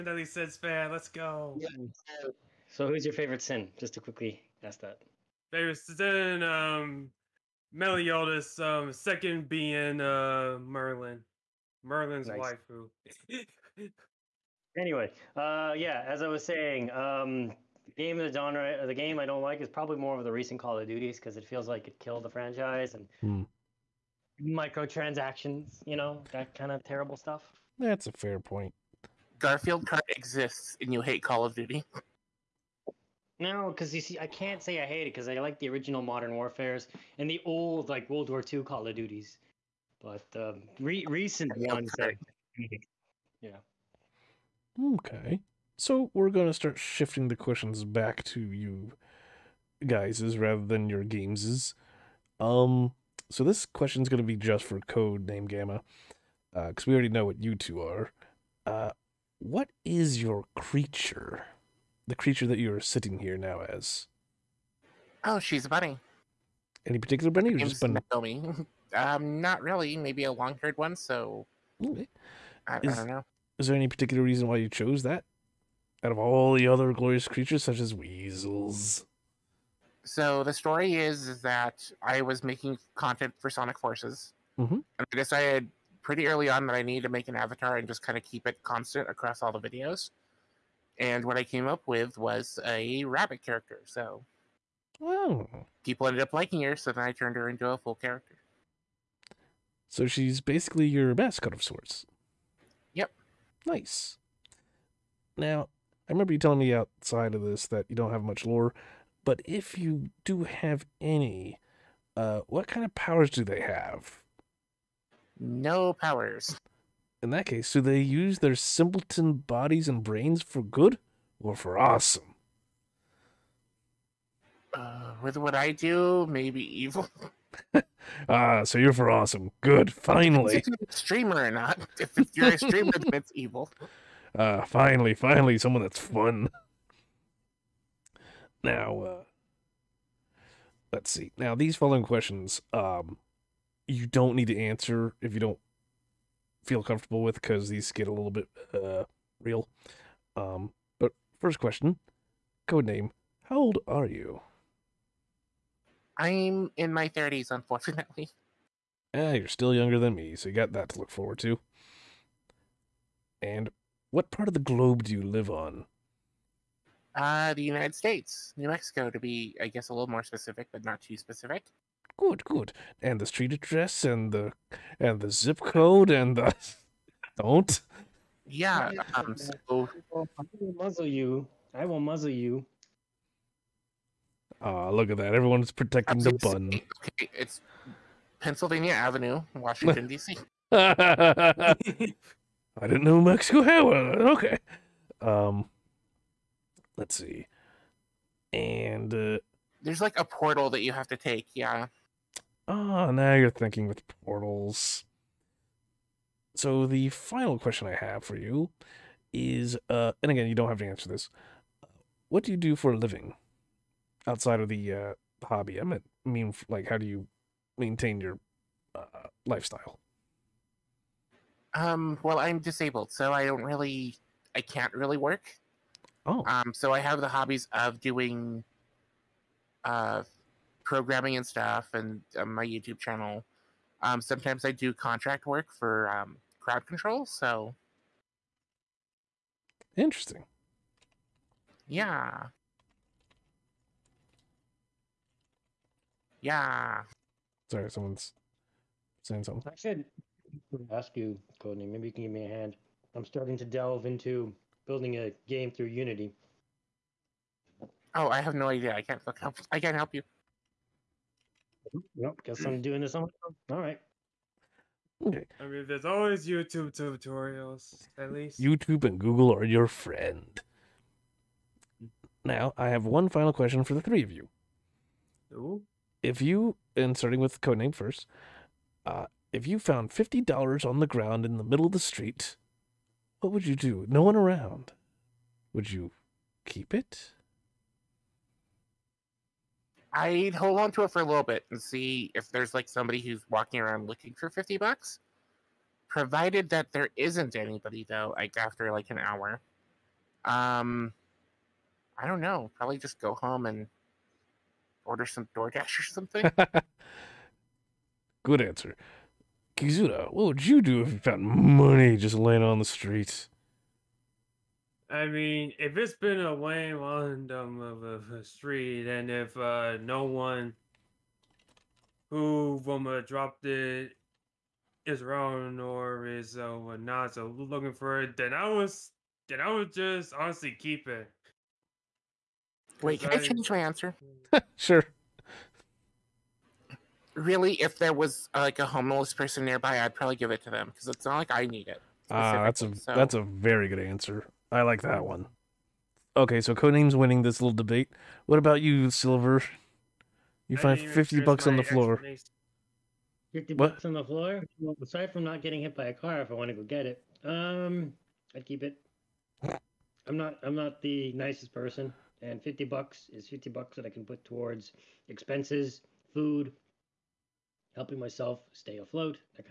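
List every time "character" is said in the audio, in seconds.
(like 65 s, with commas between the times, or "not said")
93 s, 97 s.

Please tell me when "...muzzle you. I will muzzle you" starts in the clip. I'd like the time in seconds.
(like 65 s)
180 s.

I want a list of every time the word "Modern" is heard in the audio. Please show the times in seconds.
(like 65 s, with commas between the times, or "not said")
36 s.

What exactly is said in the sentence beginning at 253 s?
I'm starting to delve into building a game through Unity.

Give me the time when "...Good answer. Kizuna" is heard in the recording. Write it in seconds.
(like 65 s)
308 s.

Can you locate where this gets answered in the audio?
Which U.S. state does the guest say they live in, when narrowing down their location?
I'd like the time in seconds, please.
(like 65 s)
168 s.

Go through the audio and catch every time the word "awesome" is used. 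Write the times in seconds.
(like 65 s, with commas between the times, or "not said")
121 s, 129 s.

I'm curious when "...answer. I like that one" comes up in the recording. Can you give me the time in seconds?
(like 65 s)
343 s.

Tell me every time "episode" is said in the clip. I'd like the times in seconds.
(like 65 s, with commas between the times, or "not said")
not said.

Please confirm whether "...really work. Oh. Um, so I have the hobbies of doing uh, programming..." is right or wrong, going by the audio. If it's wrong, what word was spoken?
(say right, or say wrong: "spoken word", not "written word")
right.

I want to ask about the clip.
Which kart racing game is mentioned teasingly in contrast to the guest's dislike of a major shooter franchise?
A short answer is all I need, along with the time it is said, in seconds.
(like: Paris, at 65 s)
Garfield Kart, at 29 s.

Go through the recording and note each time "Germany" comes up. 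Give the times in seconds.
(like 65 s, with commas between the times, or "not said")
not said.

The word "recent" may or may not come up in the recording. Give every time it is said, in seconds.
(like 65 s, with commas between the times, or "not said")
20 s, 41 s.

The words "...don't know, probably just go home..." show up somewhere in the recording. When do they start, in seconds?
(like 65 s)
302 s.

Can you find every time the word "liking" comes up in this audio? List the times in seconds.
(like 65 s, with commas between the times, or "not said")
96 s.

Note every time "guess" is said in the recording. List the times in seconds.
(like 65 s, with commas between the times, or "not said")
169 s, 262 s.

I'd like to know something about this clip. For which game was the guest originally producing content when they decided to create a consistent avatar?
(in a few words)
Sonic Forces.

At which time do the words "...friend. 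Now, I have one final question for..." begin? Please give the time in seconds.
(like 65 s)
269 s.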